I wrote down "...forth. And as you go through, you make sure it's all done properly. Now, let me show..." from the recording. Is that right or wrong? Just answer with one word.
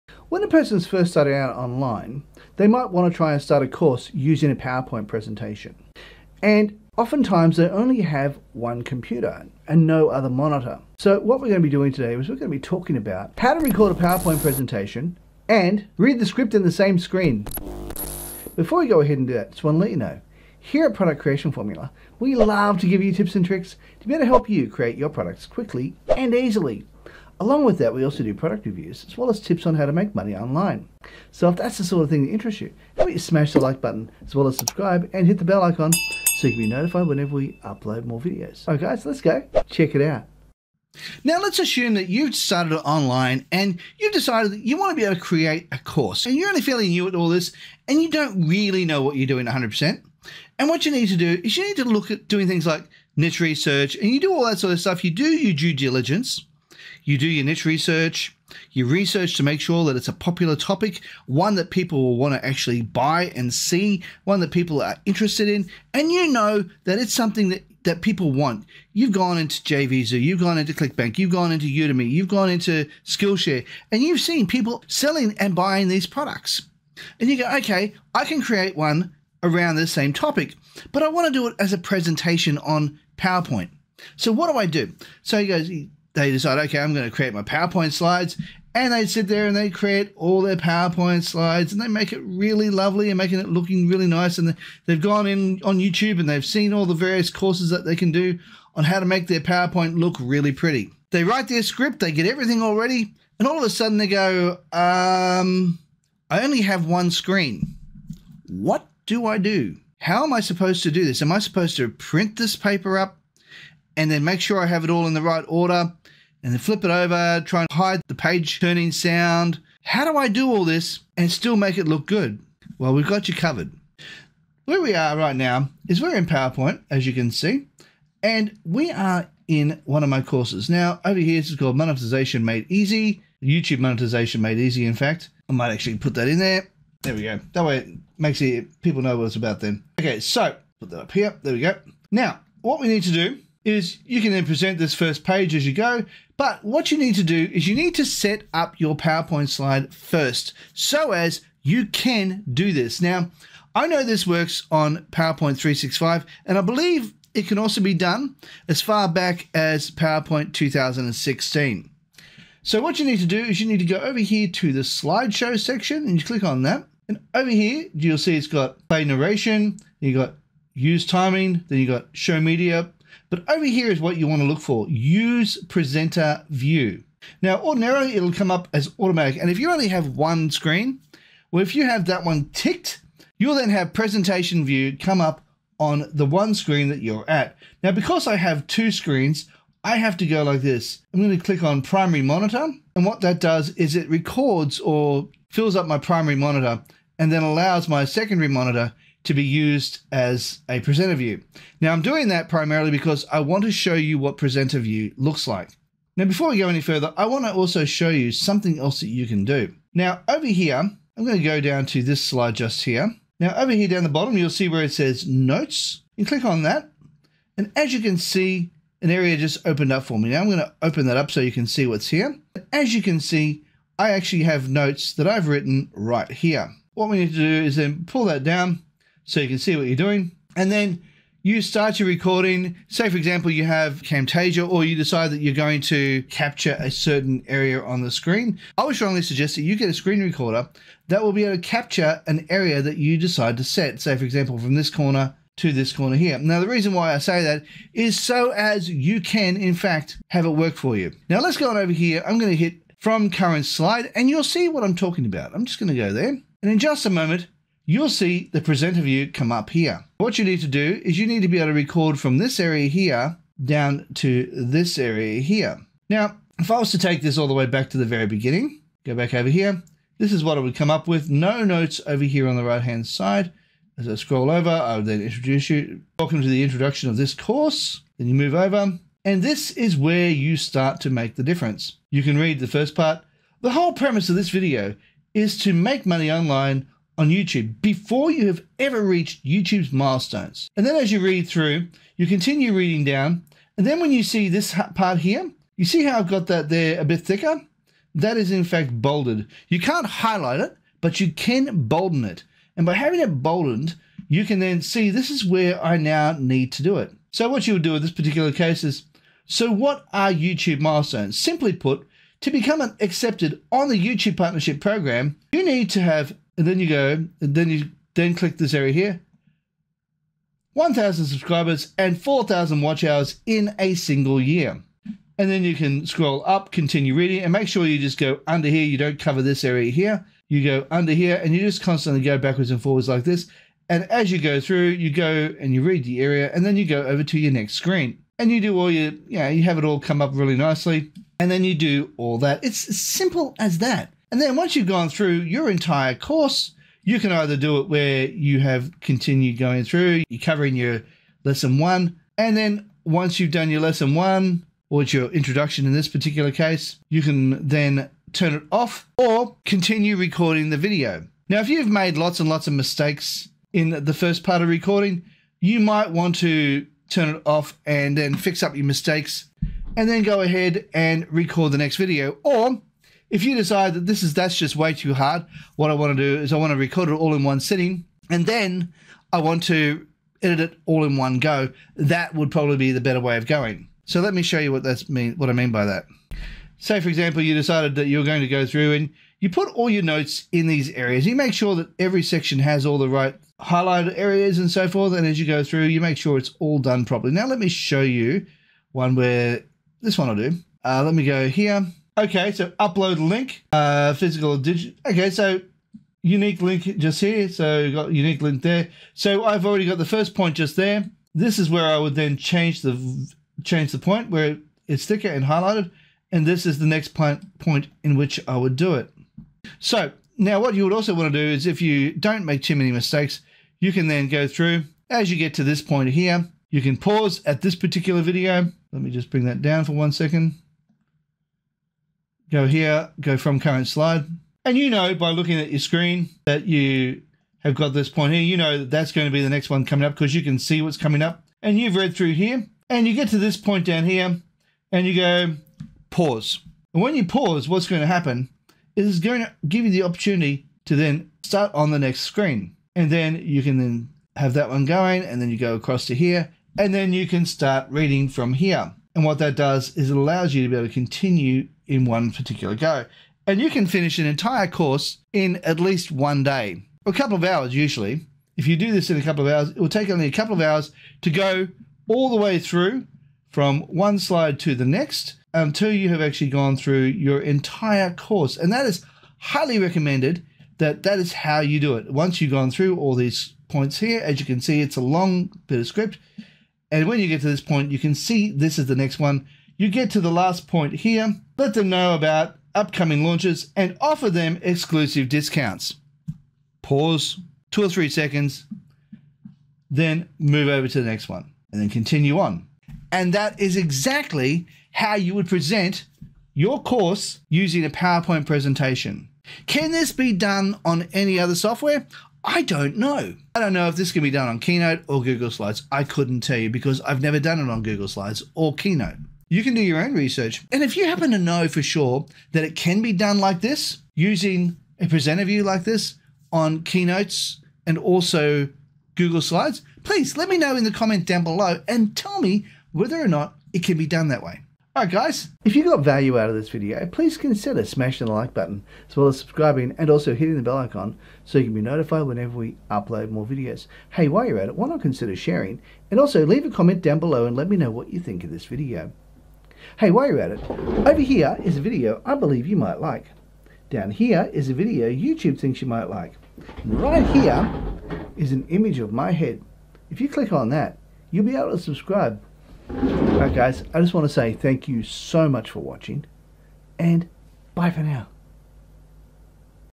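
right.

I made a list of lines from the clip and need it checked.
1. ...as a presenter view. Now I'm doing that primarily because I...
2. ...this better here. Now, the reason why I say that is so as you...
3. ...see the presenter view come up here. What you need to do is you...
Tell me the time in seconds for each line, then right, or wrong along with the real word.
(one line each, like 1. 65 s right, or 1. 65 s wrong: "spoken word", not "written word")
1. 200 s right
2. 245 s wrong: "corner", not "better"
3. 258 s right.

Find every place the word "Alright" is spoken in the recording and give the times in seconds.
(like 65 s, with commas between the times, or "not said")
38 s, 534 s, 562 s.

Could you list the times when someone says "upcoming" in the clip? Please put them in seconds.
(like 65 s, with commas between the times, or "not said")
492 s.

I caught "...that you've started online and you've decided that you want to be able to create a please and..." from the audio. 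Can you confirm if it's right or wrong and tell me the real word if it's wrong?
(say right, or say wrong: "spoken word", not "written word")
wrong: "course", not "please".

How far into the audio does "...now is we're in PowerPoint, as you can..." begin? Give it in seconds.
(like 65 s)
125 s.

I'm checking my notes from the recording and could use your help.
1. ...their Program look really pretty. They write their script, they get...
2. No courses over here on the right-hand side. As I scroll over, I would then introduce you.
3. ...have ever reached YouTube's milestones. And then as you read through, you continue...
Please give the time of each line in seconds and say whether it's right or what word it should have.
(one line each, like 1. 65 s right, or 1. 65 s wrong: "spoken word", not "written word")
1. 99 s wrong: "PowerPoint", not "Program"
2. 271 s wrong: "notes", not "courses"
3. 288 s right.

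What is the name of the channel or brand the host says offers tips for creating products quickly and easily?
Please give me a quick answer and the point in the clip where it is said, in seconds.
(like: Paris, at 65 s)
Product Creation Formula, at 20 s.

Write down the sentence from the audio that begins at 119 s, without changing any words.
How do I do all this and still make it look good?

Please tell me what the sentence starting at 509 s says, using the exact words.
Can this be done on any other software?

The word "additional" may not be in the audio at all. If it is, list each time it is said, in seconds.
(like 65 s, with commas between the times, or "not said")
not said.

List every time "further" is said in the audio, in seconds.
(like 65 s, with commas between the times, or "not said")
206 s.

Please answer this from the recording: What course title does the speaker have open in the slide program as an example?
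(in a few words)
YouTube Monetization Made Easy.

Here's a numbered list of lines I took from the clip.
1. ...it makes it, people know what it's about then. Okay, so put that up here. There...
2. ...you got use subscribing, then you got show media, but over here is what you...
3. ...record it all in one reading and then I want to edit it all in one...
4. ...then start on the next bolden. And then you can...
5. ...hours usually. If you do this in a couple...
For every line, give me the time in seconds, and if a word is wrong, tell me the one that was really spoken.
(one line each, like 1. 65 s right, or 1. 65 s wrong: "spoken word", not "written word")
1. 137 s right
2. 169 s wrong: "timing", not "subscribing"
3. 376 s wrong: "sitting", not "reading"
4. 450 s wrong: "screen", not "bolden"
5. 467 s right.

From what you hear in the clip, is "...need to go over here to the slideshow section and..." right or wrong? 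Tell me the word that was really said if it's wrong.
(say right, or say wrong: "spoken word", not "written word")
right.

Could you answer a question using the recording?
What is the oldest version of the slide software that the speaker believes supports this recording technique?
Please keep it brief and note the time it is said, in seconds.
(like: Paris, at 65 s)
PowerPoint 2016, at 159 s.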